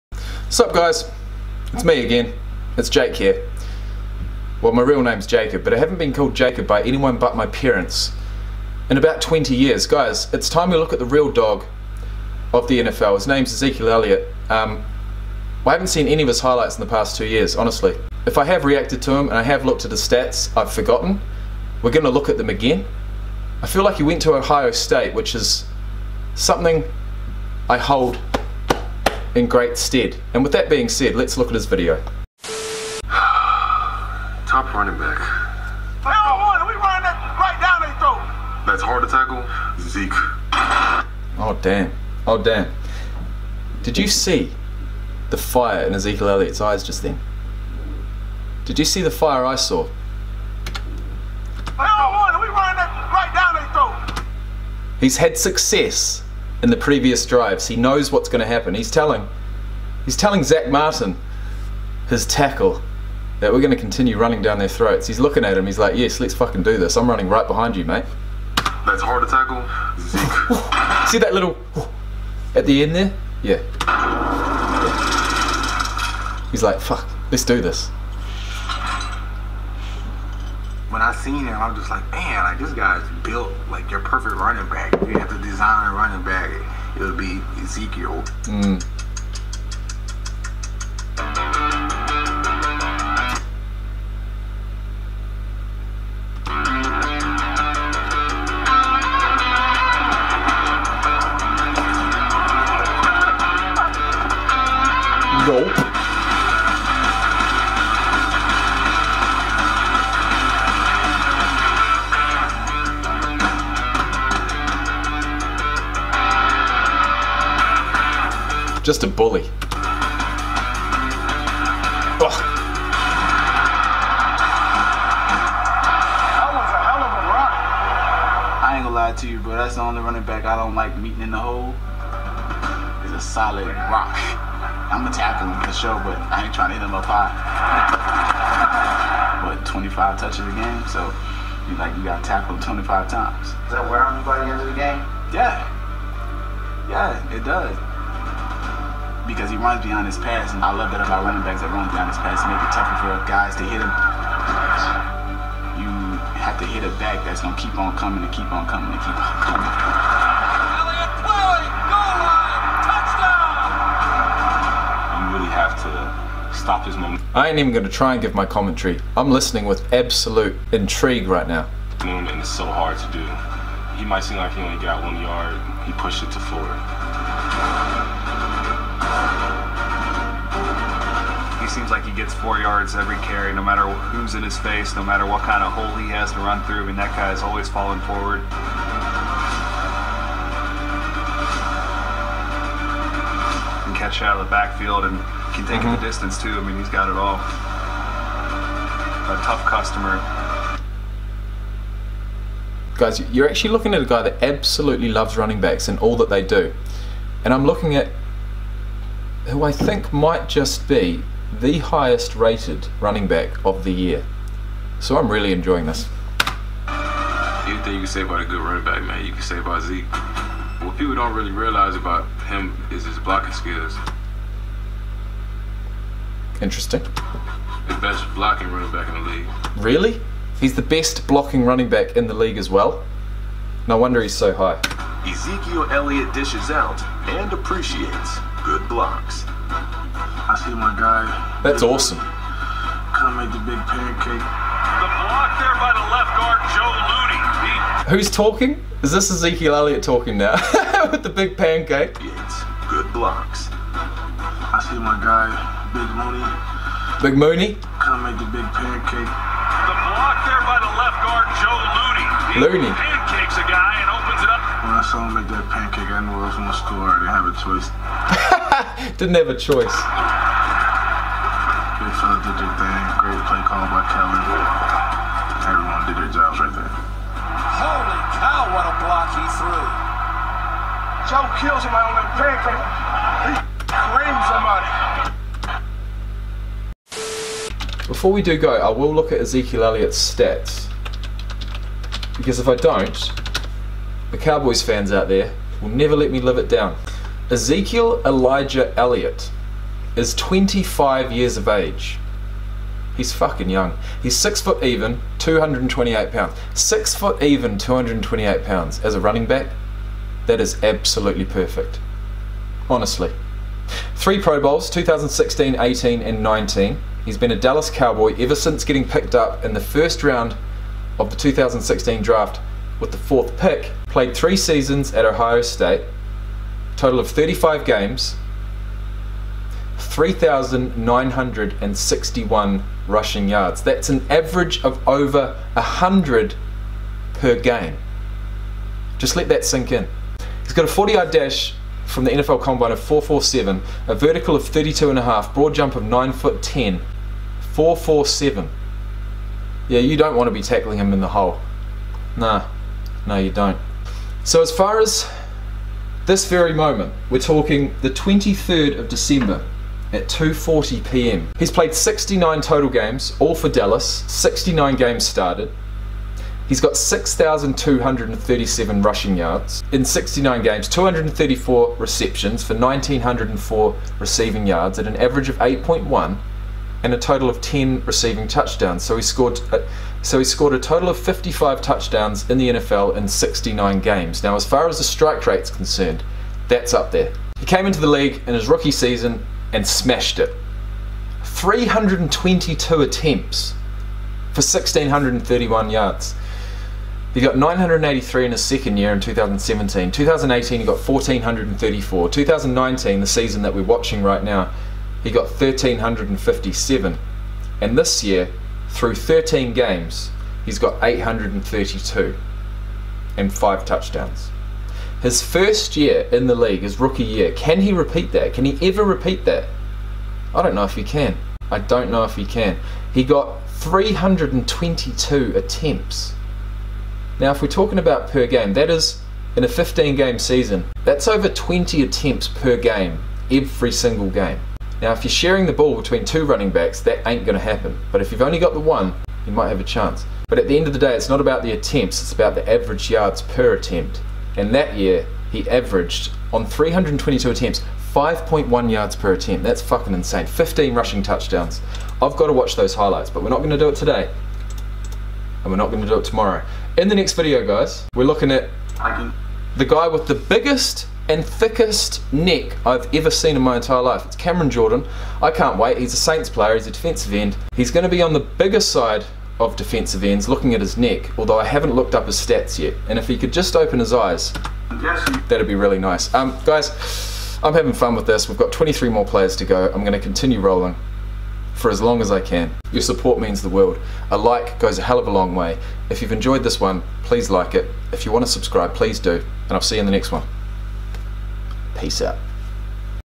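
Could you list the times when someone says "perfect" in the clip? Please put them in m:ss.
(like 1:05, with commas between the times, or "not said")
1:24, 5:11.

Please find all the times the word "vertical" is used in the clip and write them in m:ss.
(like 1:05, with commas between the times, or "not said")
5:44.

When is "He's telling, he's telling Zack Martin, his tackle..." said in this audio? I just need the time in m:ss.
0:58.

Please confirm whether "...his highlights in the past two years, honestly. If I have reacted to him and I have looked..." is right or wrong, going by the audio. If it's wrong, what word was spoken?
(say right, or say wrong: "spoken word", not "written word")
right.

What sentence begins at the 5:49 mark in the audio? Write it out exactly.
Yeah, you don't want to be tackling him in the hole.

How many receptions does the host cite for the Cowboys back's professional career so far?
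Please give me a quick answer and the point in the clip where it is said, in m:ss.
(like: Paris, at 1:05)
234, at 6:10.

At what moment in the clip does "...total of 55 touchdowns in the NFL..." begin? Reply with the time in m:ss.
6:20.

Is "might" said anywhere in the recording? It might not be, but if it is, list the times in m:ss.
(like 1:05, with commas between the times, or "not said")
2:54, 3:30, 7:19.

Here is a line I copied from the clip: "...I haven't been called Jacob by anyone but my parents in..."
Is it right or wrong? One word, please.
right.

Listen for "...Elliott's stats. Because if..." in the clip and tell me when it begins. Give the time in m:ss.
4:49.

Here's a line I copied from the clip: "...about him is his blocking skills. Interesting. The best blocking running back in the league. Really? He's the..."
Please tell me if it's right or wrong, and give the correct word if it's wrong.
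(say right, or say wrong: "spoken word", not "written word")
right.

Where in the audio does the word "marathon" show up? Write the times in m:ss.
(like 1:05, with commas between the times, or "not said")
not said.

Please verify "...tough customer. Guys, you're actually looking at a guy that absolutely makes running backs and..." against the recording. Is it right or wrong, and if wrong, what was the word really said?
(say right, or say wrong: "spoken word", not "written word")
wrong: "loves", not "makes".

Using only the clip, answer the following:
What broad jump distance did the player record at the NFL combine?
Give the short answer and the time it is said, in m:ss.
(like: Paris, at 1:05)
9 foot 10, at 5:46.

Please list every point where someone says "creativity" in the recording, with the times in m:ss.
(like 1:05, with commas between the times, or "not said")
not said.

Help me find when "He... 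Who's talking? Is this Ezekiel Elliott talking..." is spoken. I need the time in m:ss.
4:07.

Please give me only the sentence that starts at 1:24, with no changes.
If you have to design a running back, it would be Ezekiel.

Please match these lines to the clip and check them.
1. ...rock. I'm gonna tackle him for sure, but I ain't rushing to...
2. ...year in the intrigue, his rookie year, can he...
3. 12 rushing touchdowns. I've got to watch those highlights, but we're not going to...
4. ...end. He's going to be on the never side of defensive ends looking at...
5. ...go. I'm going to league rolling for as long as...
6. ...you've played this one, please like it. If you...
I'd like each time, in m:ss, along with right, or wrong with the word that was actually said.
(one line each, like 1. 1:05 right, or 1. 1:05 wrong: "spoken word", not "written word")
1. 2:13 wrong: "trying", not "rushing"
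2. 6:55 wrong: "league", not "intrigue"
3. 7:30 wrong: "15", not "12"
4. 7:47 wrong: "bigger", not "never"
5. 7:59 wrong: "continue", not "league"
6. 8:06 wrong: "enjoyed", not "played".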